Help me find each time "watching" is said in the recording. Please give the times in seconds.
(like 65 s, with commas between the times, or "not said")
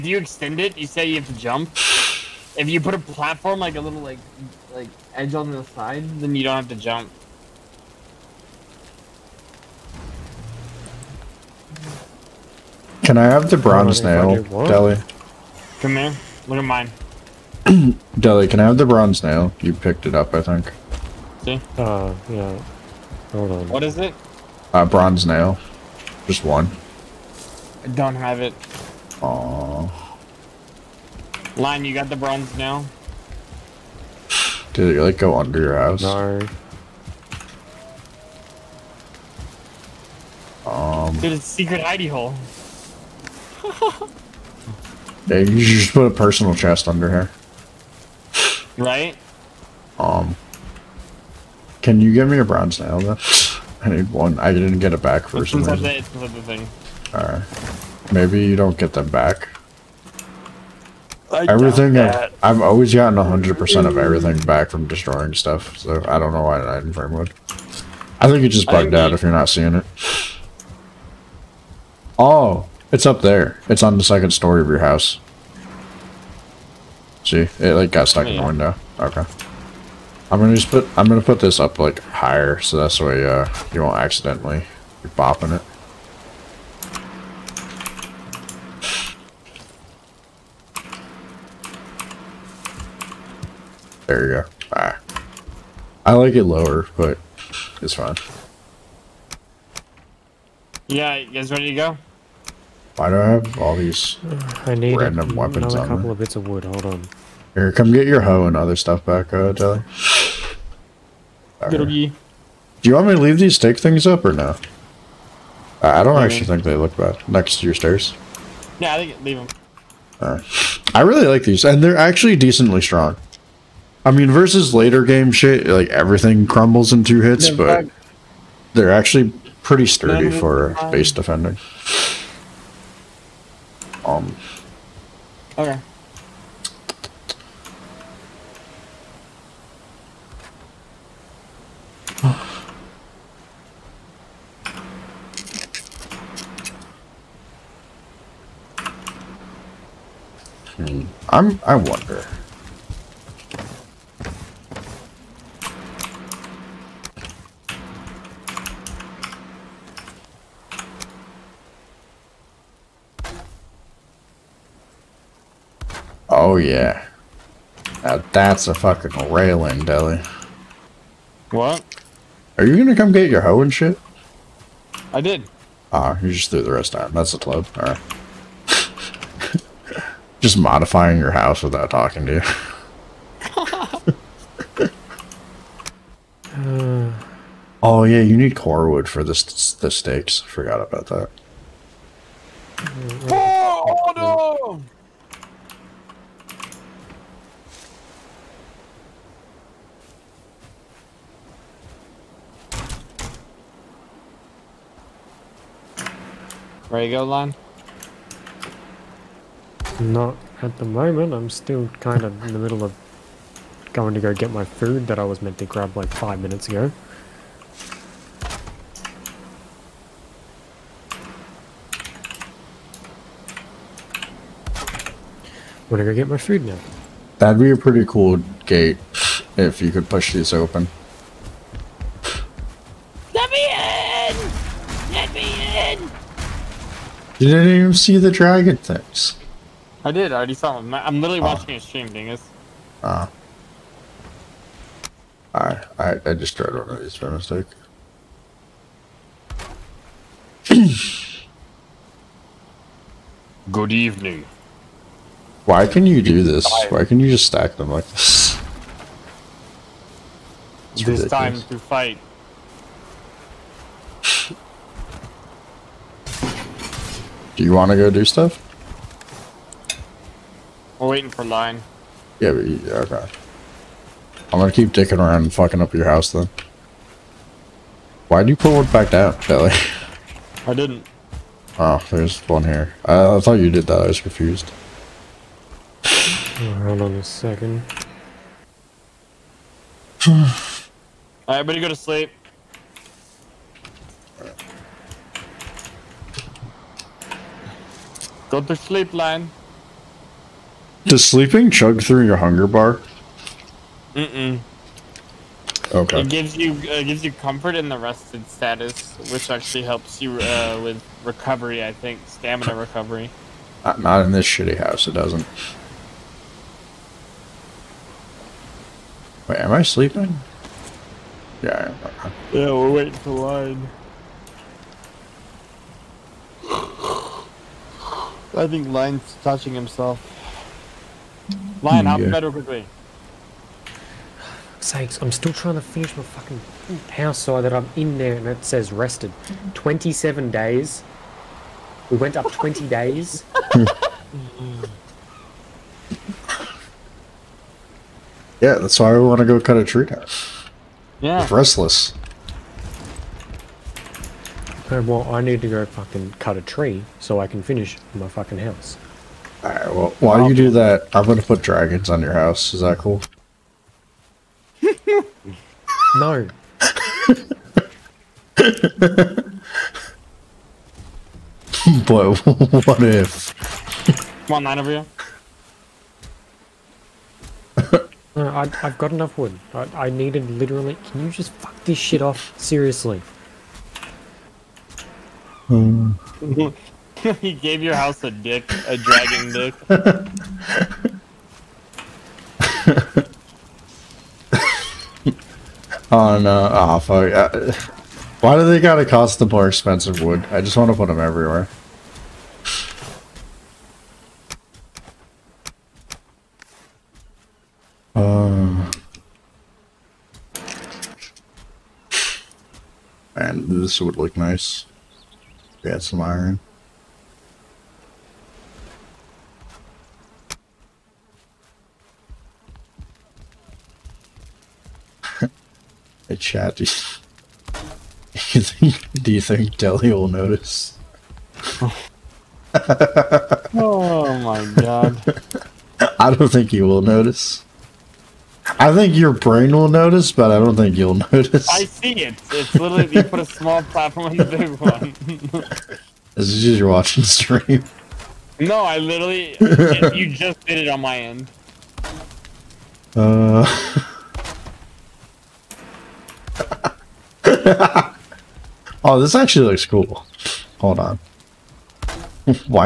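241 s, 446 s.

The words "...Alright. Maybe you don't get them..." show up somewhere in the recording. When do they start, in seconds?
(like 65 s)
57 s.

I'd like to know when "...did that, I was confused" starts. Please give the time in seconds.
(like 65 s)
283 s.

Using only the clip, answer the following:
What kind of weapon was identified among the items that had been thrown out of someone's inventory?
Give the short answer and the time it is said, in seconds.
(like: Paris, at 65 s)
Club, at 177 s.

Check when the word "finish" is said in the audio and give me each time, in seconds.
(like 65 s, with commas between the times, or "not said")
335 s, 357 s.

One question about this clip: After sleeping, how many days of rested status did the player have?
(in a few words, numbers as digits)
27 days.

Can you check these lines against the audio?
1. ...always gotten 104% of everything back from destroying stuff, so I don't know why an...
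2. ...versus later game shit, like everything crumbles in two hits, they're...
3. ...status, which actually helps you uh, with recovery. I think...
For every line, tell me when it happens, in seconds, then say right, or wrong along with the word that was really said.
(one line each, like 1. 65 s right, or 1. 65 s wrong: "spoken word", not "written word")
1. 62 s wrong: "100", not "104"
2. 124 s right
3. 308 s right.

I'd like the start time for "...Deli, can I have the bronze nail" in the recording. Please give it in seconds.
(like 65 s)
18 s.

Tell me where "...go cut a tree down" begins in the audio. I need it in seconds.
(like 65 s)
349 s.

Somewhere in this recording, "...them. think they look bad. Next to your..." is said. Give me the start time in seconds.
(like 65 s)
116 s.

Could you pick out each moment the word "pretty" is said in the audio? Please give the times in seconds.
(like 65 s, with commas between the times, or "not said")
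129 s, 227 s.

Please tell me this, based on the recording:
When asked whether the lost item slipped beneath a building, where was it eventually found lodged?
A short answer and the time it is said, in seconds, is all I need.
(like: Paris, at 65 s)
In the window, at 78 s.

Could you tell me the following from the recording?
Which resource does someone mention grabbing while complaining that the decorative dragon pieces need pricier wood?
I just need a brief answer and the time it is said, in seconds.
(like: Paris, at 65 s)
Iron, at 416 s.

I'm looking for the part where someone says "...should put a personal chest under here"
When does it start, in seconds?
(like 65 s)
45 s.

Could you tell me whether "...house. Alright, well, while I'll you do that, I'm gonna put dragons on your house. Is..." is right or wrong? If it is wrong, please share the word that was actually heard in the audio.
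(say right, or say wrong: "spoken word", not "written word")
right.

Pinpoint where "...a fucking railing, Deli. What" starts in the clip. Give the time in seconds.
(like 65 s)
168 s.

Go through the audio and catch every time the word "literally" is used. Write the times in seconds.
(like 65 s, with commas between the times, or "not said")
241 s, 380 s, 442 s, 448 s.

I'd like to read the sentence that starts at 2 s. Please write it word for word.
If you put a platform like a little like like edge on the side, then you don't have to jump.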